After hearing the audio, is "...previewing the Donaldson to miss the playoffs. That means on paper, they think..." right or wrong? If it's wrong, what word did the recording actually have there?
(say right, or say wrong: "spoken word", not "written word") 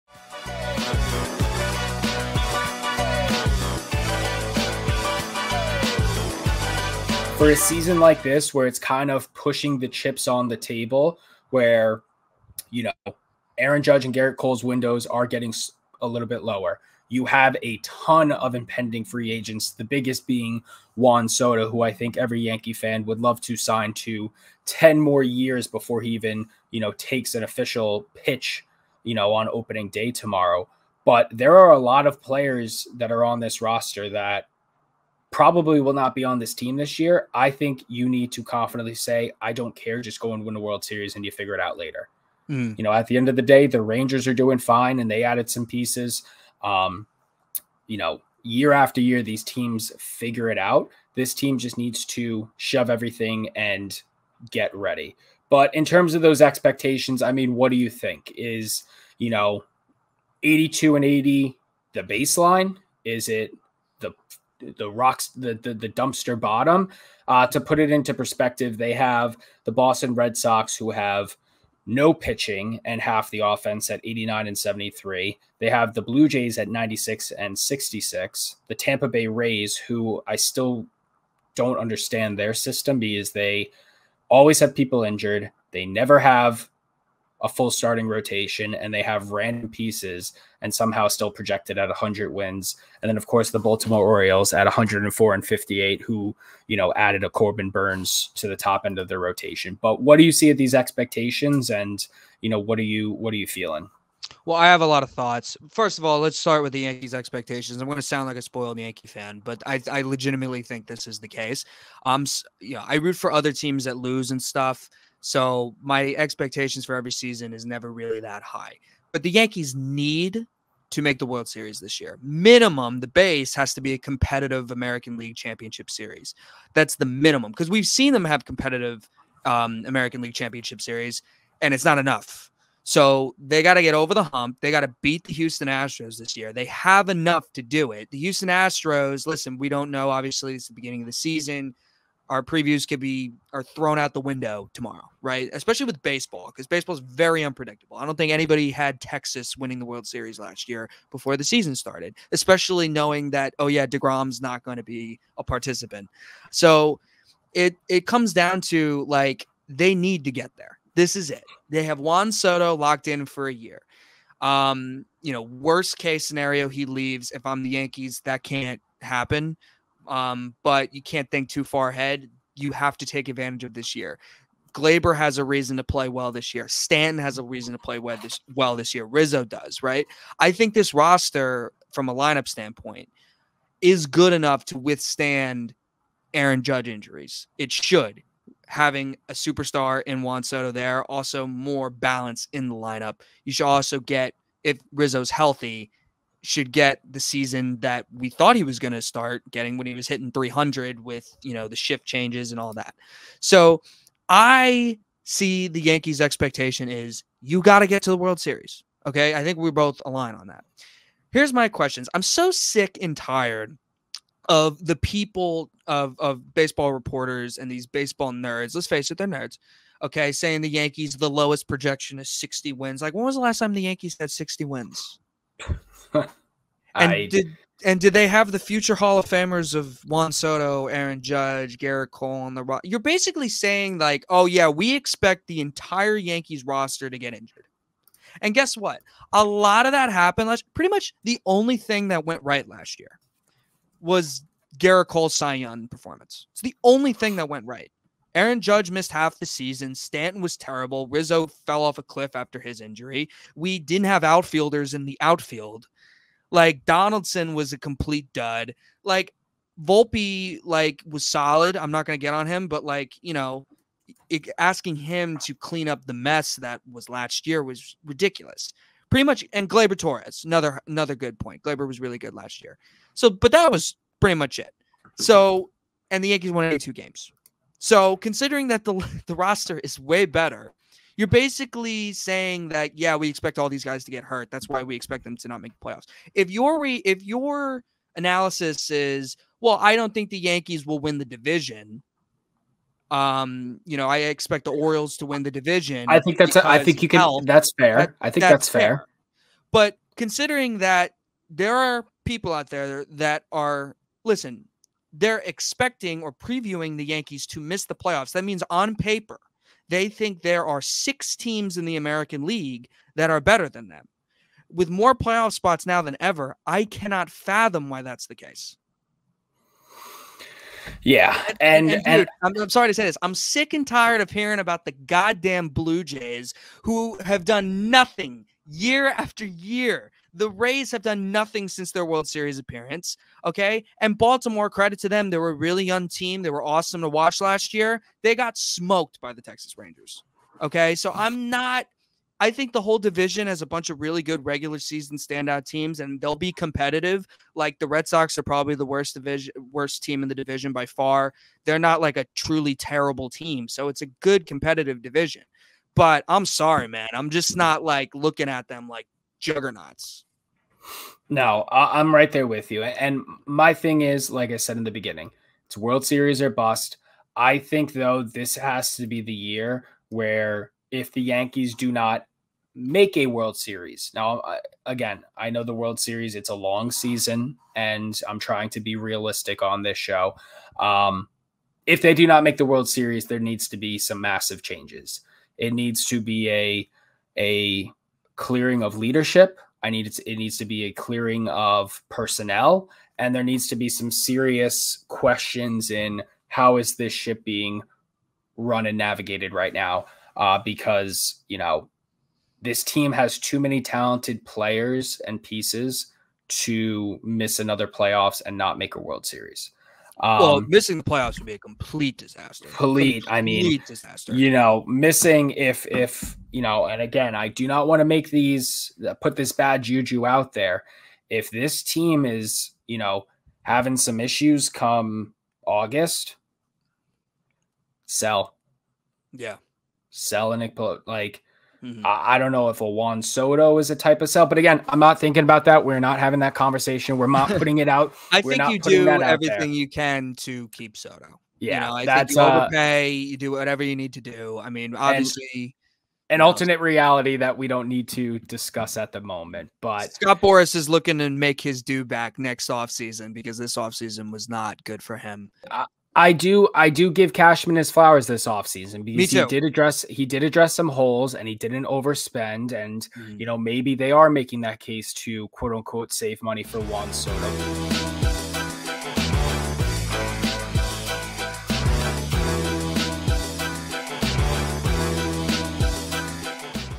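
wrong: "Yankees", not "Donaldson".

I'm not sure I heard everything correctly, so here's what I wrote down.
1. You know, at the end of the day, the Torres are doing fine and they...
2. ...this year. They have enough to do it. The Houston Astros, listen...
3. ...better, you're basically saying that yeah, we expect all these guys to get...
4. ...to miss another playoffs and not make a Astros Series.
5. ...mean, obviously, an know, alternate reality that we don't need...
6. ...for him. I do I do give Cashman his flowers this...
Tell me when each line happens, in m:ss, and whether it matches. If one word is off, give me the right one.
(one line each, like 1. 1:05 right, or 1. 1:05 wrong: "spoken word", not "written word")
1. 0:42 wrong: "Rangers", not "Torres"
2. 2:16 right
3. 4:40 right
4. 6:46 wrong: "World", not "Astros"
5. 7:24 right
6. 7:35 right.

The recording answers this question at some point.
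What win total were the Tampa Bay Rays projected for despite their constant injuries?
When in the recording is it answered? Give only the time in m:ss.
1:31.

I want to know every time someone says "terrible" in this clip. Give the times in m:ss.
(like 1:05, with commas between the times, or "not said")
4:10, 5:52.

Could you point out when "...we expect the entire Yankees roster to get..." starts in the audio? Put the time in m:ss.
3:54.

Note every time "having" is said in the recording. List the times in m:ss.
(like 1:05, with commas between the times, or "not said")
3:08, 7:03, 7:16.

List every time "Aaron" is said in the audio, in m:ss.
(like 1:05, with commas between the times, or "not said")
0:13, 3:06, 3:50, 4:08.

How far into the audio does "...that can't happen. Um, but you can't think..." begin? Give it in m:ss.
2:48.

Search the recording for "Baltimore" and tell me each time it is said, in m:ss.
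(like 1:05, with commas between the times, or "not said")
1:33, 5:34.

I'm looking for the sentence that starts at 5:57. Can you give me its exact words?
I'm just not like looking at them like juggernauts.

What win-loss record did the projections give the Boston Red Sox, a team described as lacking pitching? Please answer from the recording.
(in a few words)
89 and 73.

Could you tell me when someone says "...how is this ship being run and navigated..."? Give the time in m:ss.
6:36.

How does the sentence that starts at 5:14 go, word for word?
With more playoff spots now than ever, I cannot fathom why that's the case.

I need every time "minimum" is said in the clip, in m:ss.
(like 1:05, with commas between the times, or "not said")
2:02, 2:07.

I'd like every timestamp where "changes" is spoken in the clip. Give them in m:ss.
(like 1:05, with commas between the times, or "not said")
3:22, 6:24.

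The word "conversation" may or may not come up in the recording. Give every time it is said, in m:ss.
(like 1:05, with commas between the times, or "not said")
7:16.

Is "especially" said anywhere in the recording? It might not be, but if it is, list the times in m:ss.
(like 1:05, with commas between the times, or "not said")
2:25, 2:32.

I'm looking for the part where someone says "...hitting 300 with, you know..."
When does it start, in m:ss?
3:20.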